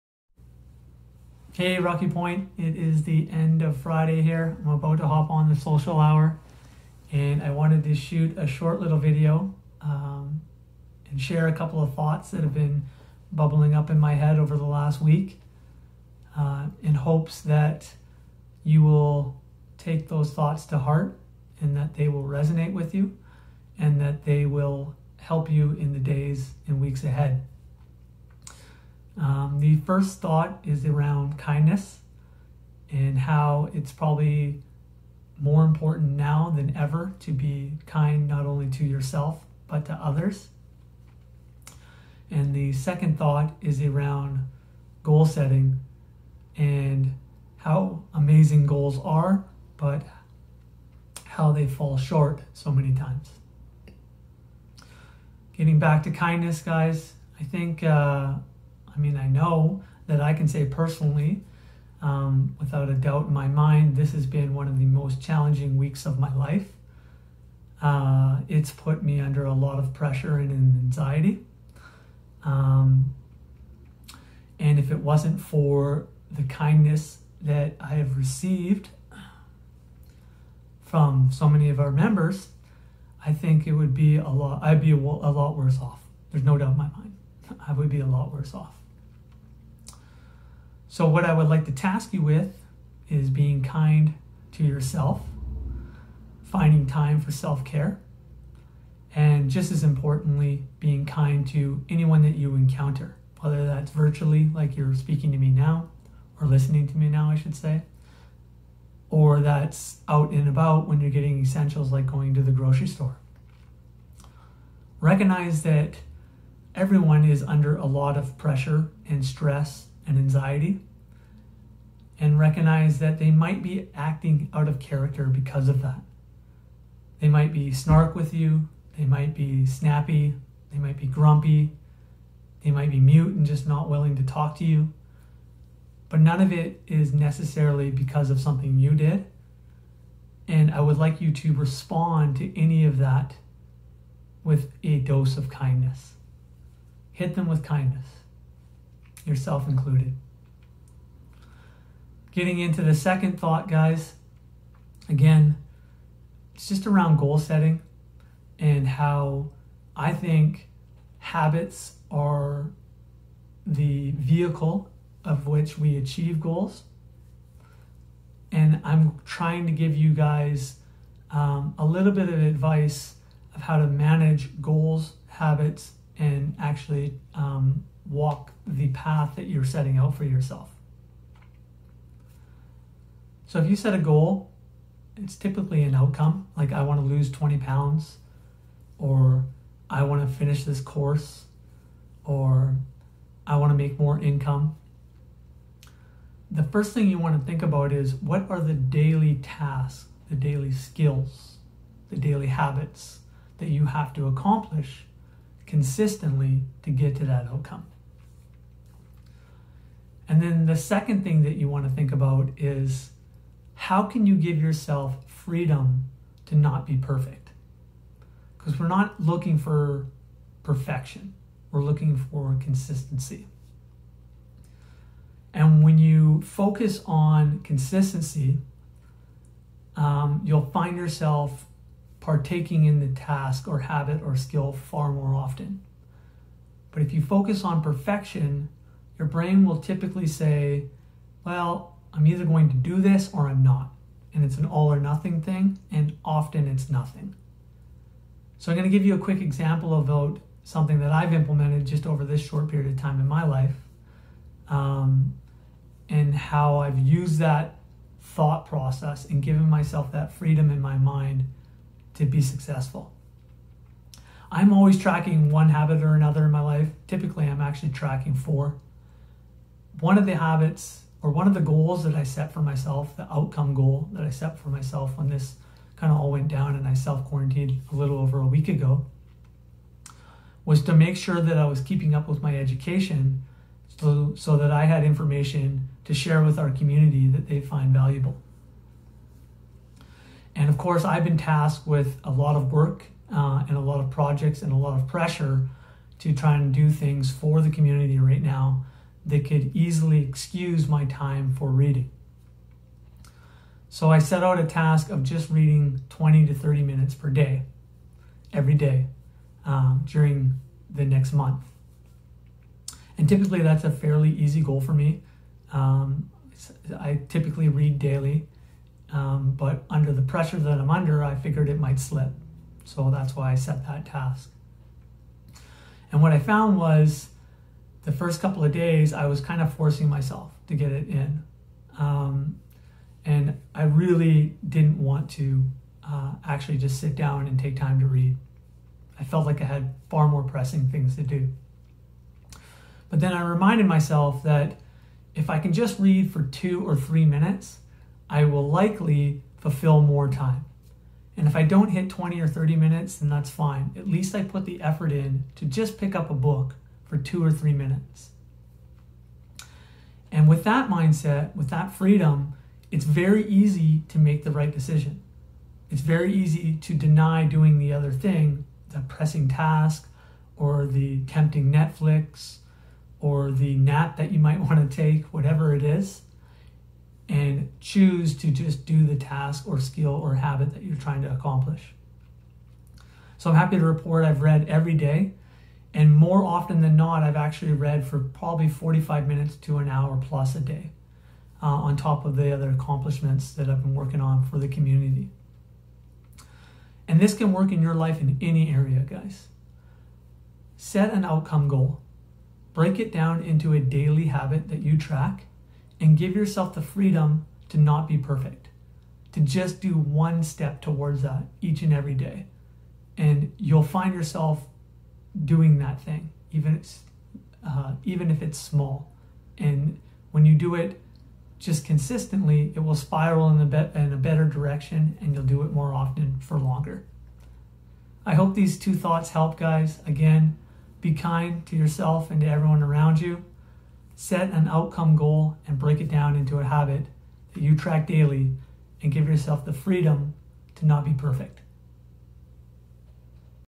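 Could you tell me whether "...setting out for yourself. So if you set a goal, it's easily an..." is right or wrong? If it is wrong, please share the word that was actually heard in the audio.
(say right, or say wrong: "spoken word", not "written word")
wrong: "typically", not "easily".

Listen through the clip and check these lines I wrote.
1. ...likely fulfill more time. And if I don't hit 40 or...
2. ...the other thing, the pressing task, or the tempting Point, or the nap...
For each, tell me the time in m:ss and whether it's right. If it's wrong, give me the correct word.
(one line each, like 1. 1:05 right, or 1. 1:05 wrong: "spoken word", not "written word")
1. 5:48 wrong: "20", not "40"
2. 6:07 wrong: "Netflix", not "Point".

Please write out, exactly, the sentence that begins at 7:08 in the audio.
I hope these two thoughts help, guys.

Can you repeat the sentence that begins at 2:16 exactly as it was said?
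But none of it is necessarily because of something you did.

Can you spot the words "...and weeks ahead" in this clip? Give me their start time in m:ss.
0:26.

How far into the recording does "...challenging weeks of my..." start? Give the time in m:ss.
1:05.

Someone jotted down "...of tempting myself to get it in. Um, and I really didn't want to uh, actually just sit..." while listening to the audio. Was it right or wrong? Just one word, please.
wrong.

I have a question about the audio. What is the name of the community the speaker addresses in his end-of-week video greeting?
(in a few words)
Rocky Point.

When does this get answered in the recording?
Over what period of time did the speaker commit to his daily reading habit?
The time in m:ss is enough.
5:10.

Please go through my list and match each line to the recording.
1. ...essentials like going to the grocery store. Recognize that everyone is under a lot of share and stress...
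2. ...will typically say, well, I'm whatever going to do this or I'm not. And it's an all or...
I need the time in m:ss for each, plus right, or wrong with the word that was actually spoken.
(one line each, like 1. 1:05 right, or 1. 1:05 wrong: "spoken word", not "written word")
1. 1:51 wrong: "pressure", not "share"
2. 3:59 wrong: "either", not "whatever".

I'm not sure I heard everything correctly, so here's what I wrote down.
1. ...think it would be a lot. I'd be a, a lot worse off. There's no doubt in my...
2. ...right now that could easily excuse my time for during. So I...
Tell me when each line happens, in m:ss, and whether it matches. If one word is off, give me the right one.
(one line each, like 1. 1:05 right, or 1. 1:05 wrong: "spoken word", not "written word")
1. 1:23 right
2. 4:58 wrong: "reading", not "during".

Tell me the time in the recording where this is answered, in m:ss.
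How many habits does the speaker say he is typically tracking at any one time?
4:28.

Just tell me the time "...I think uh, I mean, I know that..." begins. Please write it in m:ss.
0:57.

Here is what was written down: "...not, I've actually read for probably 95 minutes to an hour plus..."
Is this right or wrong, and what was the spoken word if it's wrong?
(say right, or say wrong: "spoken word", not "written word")
wrong: "45", not "95".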